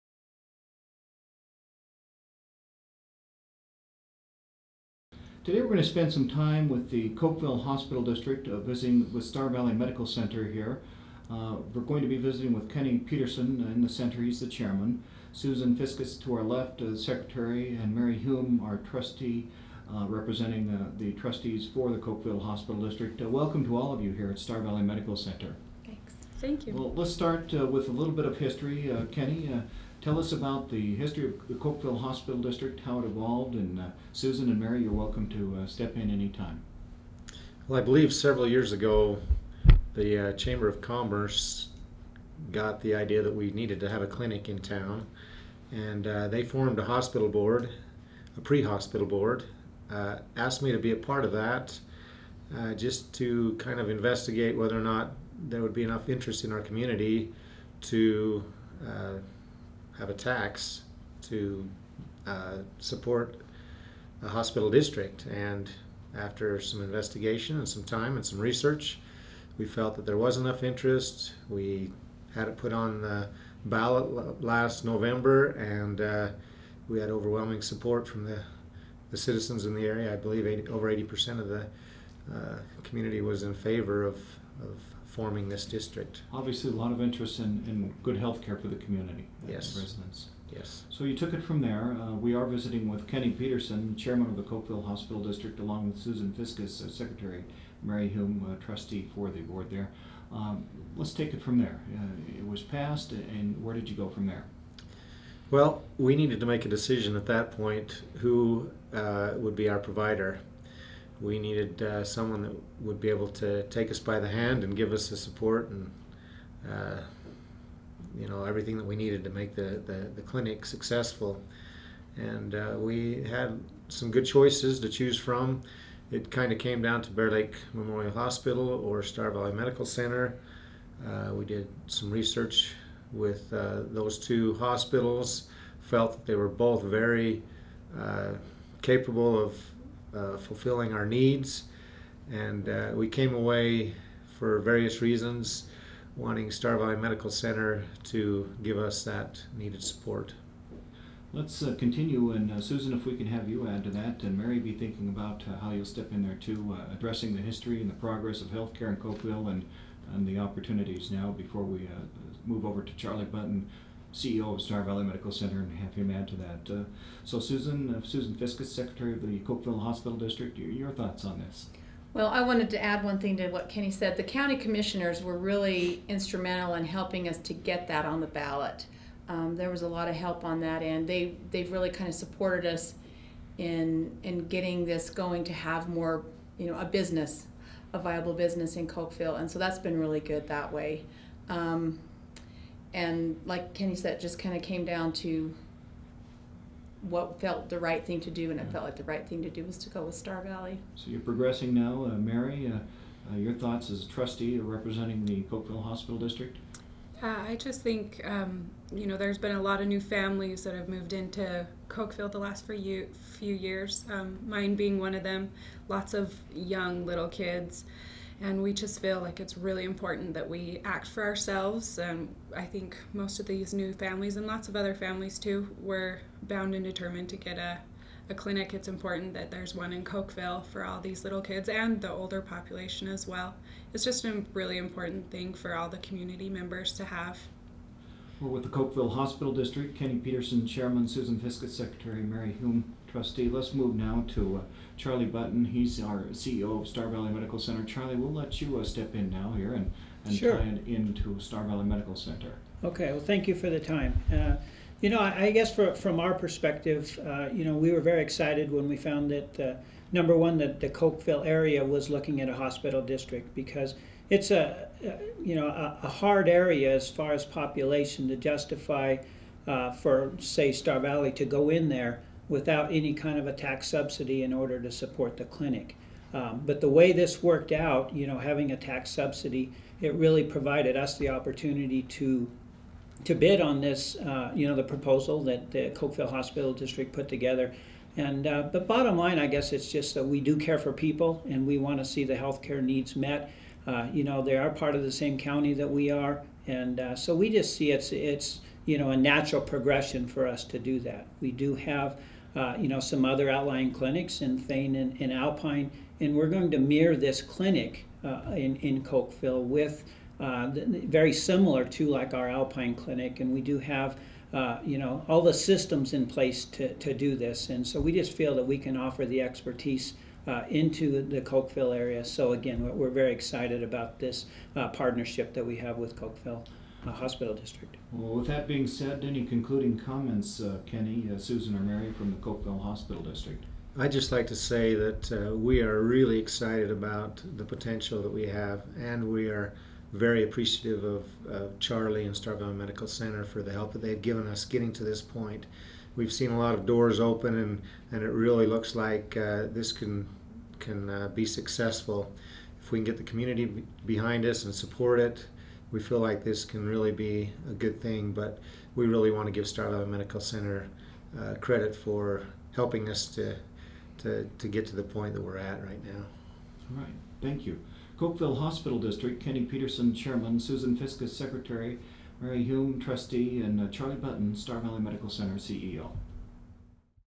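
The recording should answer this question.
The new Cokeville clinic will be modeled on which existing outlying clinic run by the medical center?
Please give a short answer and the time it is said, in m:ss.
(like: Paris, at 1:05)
Alpine clinic, at 5:12.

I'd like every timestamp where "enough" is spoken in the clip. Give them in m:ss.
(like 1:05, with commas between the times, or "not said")
0:55, 1:10.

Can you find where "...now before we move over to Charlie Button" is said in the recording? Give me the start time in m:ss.
2:41.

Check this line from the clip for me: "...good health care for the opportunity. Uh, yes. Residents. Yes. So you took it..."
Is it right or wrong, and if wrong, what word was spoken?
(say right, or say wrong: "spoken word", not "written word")
wrong: "community", not "opportunity".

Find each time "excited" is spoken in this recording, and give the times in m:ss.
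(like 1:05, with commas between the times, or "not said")
4:18, 5:23, 5:36.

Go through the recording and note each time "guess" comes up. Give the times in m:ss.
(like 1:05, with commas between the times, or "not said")
4:15, 4:49.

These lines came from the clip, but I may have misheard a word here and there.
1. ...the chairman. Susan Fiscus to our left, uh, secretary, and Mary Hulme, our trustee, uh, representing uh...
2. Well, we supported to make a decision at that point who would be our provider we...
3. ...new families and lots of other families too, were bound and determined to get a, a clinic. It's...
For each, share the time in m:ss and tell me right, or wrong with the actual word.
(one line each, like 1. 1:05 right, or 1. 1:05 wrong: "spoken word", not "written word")
1. 0:14 right
2. 1:45 wrong: "needed", not "supported"
3. 3:43 right.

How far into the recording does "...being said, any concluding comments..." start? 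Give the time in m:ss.
5:28.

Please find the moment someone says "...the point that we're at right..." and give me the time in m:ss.
6:04.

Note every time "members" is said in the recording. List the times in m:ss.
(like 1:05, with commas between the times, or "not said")
3:56.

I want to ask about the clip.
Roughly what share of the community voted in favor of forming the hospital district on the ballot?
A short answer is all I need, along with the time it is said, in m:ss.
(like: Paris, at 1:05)
over 80%, at 1:20.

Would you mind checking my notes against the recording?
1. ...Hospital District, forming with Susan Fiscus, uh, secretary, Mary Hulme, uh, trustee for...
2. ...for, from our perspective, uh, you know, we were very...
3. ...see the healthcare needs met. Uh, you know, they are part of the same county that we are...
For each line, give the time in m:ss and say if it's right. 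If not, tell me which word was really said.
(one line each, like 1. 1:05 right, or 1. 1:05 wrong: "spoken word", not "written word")
1. 1:34 wrong: "along", not "forming"
2. 4:15 right
3. 4:52 right.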